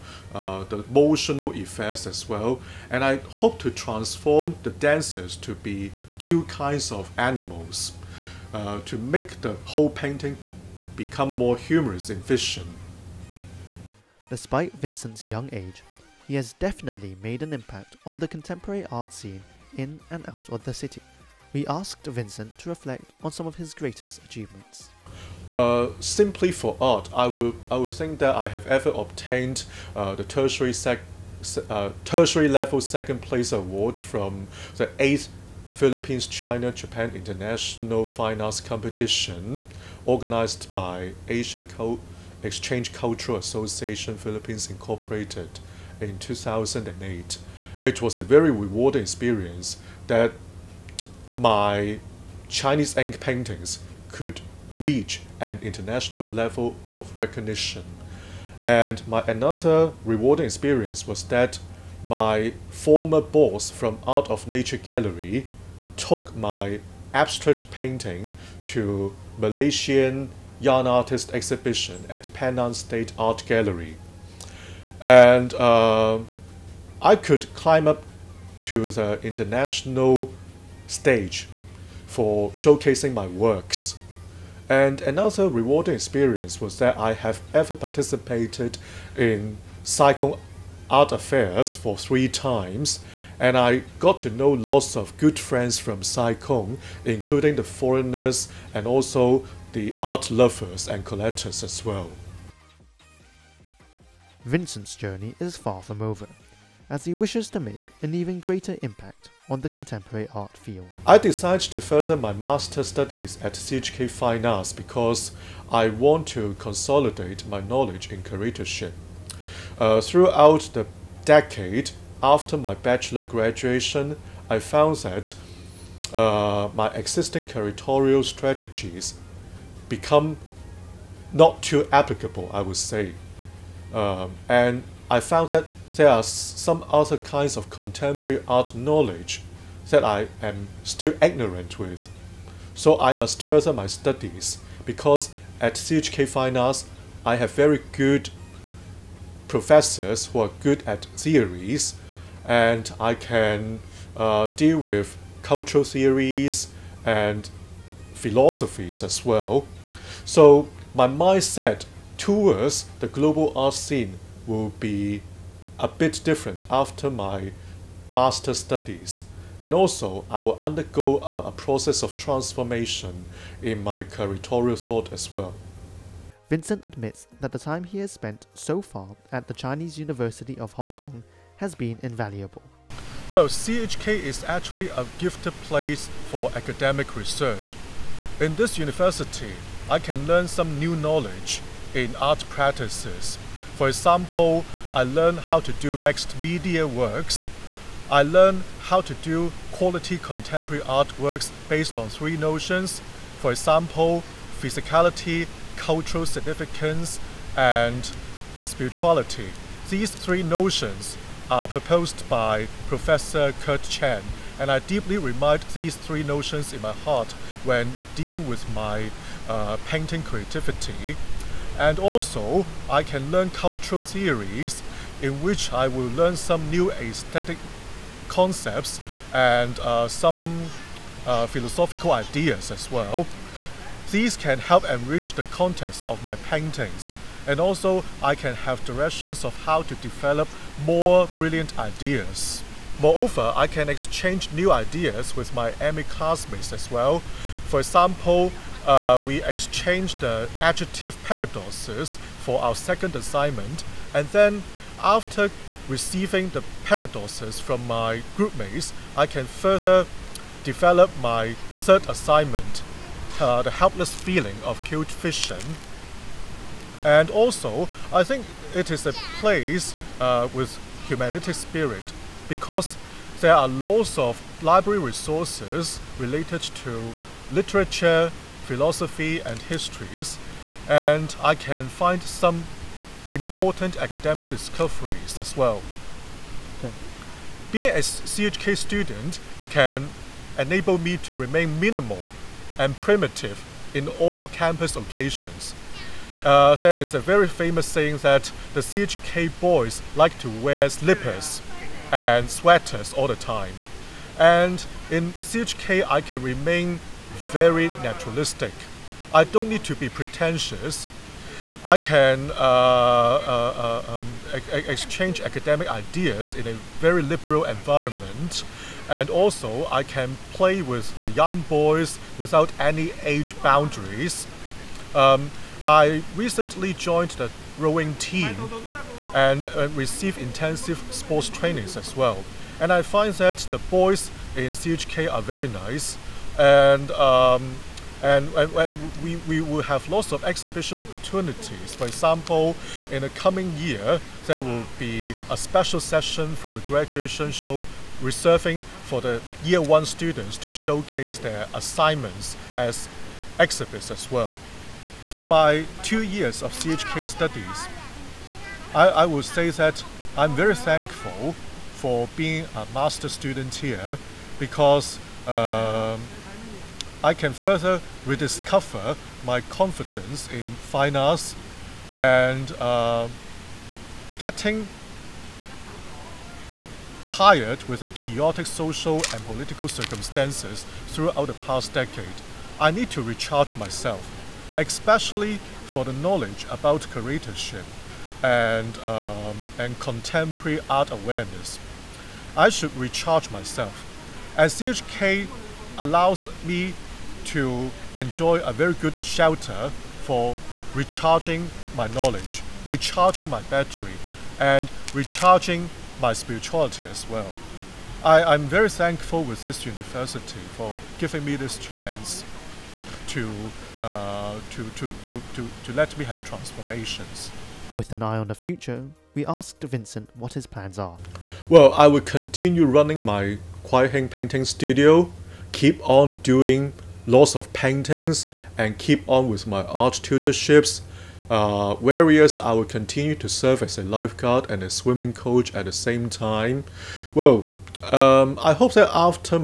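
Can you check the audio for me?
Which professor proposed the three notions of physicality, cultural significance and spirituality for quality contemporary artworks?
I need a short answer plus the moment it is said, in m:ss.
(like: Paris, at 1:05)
Kurt Chan, at 3:33.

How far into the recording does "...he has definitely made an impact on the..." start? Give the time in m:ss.
0:16.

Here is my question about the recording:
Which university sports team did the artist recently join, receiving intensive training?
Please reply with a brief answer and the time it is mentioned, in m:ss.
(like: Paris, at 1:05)
rowing team, at 5:27.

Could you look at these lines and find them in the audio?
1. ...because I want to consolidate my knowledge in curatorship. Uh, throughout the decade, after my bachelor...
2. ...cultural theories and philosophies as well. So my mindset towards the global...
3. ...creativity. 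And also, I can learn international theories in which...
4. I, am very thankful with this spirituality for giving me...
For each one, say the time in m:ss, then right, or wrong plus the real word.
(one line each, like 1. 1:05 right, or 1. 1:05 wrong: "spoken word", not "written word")
1. 1:54 right
2. 2:35 right
3. 3:40 wrong: "cultural", not "international"
4. 6:48 wrong: "university", not "spirituality".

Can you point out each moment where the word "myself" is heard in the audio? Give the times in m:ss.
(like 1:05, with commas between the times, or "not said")
6:23, 6:33.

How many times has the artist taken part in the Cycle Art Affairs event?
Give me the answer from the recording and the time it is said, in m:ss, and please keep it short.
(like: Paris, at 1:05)
3, at 1:31.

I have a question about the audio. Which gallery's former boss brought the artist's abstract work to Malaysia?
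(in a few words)
Art of Nature Gallery.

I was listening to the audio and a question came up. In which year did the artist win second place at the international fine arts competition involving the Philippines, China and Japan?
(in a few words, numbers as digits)
2008.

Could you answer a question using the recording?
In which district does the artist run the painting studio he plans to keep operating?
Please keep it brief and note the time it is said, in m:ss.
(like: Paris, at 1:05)
Kwai Hing, at 7:03.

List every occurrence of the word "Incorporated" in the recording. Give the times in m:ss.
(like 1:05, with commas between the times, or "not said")
0:44.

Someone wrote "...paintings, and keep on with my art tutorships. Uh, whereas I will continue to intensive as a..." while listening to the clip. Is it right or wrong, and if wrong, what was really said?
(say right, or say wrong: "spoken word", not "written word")
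wrong: "serve", not "intensive".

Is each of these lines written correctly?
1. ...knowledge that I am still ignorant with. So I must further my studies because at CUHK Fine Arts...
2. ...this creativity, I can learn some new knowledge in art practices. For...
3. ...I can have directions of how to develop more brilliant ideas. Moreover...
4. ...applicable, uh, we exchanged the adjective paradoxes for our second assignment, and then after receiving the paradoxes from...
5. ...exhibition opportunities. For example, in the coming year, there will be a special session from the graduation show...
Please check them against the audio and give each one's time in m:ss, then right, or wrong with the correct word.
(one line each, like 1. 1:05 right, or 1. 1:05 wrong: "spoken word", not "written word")
1. 2:18 right
2. 3:08 wrong: "university", not "creativity"
3. 3:58 right
4. 4:07 wrong: "example", not "applicable"
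5. 5:40 right.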